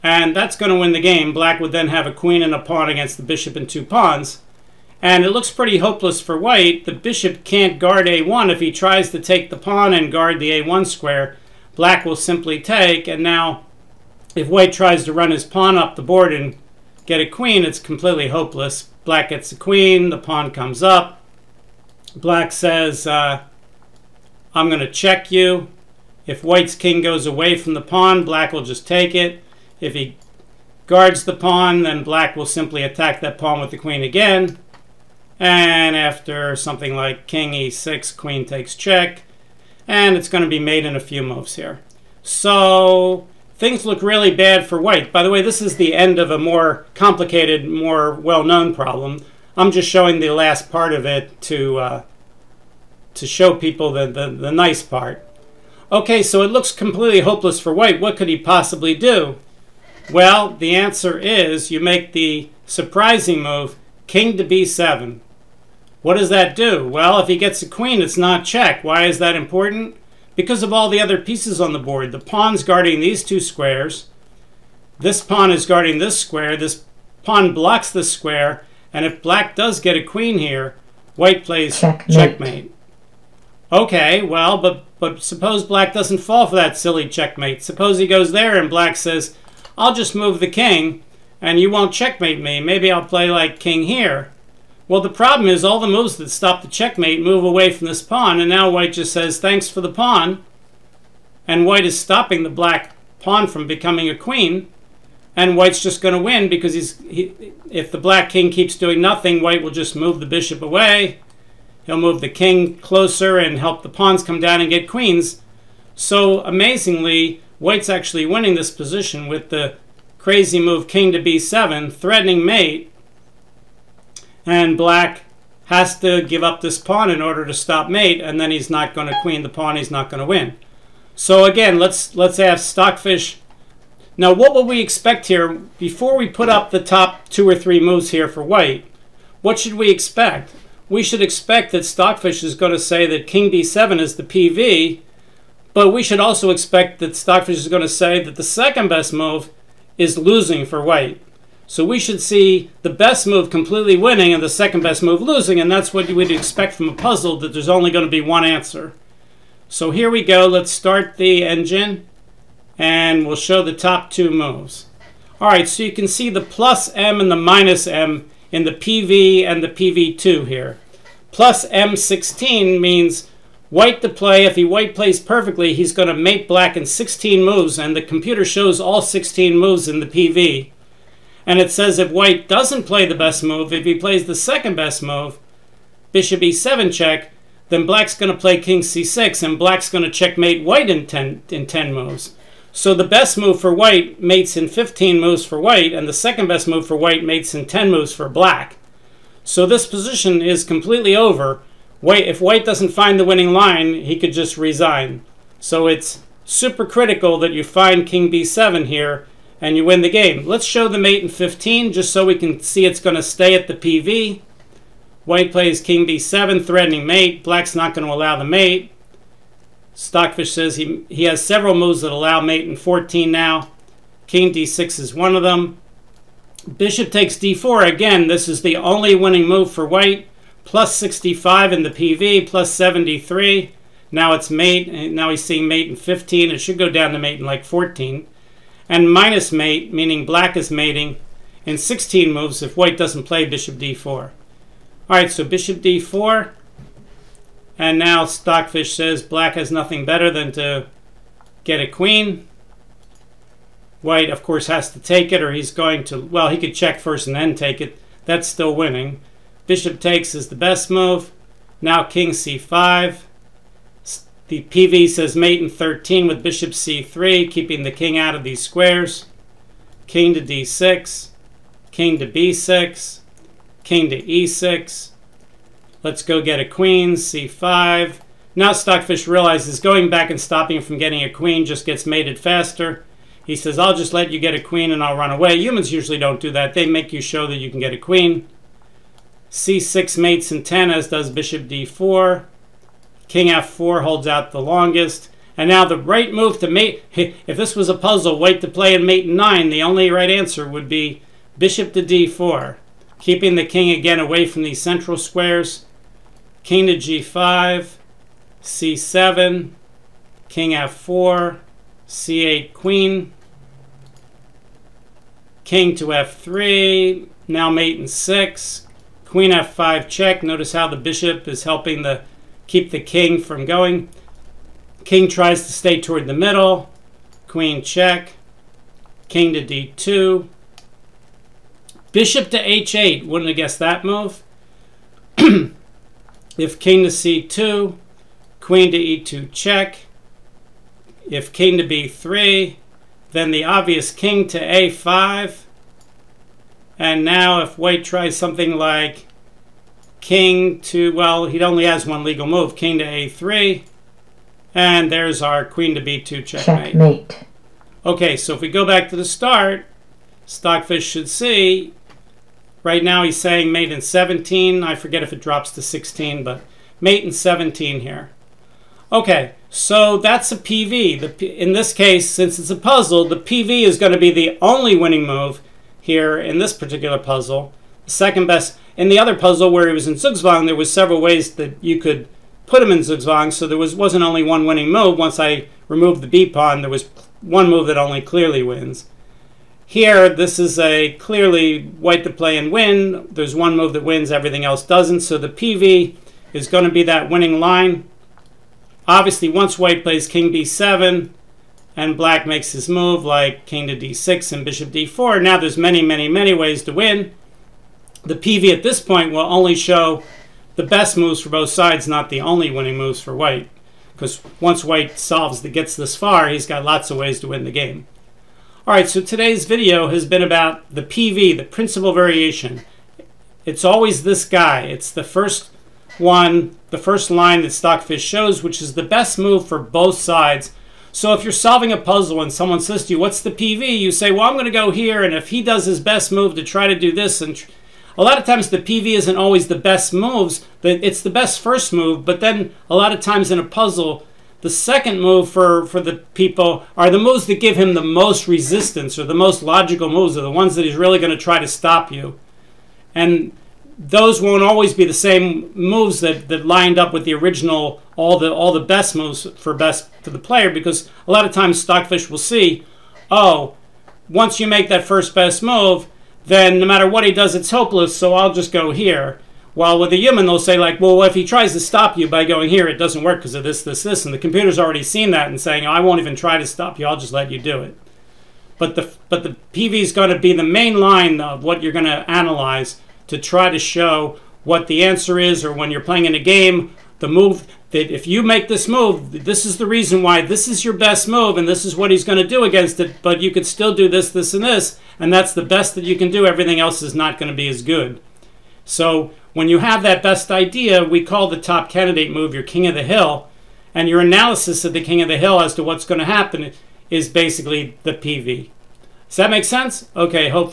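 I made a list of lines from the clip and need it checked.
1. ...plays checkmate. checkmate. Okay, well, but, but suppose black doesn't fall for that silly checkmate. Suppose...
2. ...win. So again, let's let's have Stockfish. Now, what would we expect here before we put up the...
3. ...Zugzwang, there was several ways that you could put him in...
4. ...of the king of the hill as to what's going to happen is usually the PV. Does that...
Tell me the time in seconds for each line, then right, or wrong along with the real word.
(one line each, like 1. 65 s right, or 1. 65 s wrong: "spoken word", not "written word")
1. 81 s right
2. 130 s right
3. 380 s right
4. 504 s wrong: "basically", not "usually".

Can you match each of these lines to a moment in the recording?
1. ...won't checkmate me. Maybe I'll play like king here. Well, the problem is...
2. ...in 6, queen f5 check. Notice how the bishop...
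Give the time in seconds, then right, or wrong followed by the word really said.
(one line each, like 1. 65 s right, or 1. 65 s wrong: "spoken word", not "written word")
1. 91 s right
2. 317 s right.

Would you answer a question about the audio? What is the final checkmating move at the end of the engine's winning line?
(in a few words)
Queen to b2.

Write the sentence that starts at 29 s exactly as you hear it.
If he guards the pawn, then black will simply attack that pawn with the queen again.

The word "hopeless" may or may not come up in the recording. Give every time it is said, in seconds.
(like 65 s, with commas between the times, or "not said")
5 s, 18 s, 57 s, 467 s.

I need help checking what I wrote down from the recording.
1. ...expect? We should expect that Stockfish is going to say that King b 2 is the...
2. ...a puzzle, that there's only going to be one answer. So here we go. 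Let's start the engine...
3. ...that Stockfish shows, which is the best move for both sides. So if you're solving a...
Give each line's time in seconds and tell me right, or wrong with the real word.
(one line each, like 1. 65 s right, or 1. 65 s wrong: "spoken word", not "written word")
1. 139 s wrong: "7", not "2"
2. 156 s right
3. 427 s right.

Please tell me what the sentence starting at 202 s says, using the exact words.
White, if white doesn't find the winning line, he could just resign.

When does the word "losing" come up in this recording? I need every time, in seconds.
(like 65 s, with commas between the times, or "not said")
150 s, 155 s.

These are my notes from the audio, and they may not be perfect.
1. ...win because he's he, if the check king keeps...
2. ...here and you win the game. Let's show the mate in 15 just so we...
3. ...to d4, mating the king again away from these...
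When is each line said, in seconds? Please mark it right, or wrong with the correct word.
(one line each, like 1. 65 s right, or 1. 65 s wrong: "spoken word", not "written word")
1. 106 s wrong: "black", not "check"
2. 208 s right
3. 301 s wrong: "keeping", not "mating".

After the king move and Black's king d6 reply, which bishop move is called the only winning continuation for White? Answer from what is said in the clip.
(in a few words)
Bishop takes d4.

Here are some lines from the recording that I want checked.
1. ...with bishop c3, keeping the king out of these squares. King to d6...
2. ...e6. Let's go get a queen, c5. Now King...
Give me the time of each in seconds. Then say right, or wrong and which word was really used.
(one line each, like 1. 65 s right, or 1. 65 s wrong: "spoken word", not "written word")
1. 266 s right
2. 274 s wrong: "Stockfish", not "King".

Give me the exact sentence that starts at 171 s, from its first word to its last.
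Plus M16 means white to play.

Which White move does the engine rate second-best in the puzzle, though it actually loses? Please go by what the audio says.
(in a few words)
Bishop e7 check.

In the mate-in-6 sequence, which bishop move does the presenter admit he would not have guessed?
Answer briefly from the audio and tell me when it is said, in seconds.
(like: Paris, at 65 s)
Bishop to h8, at 332 s.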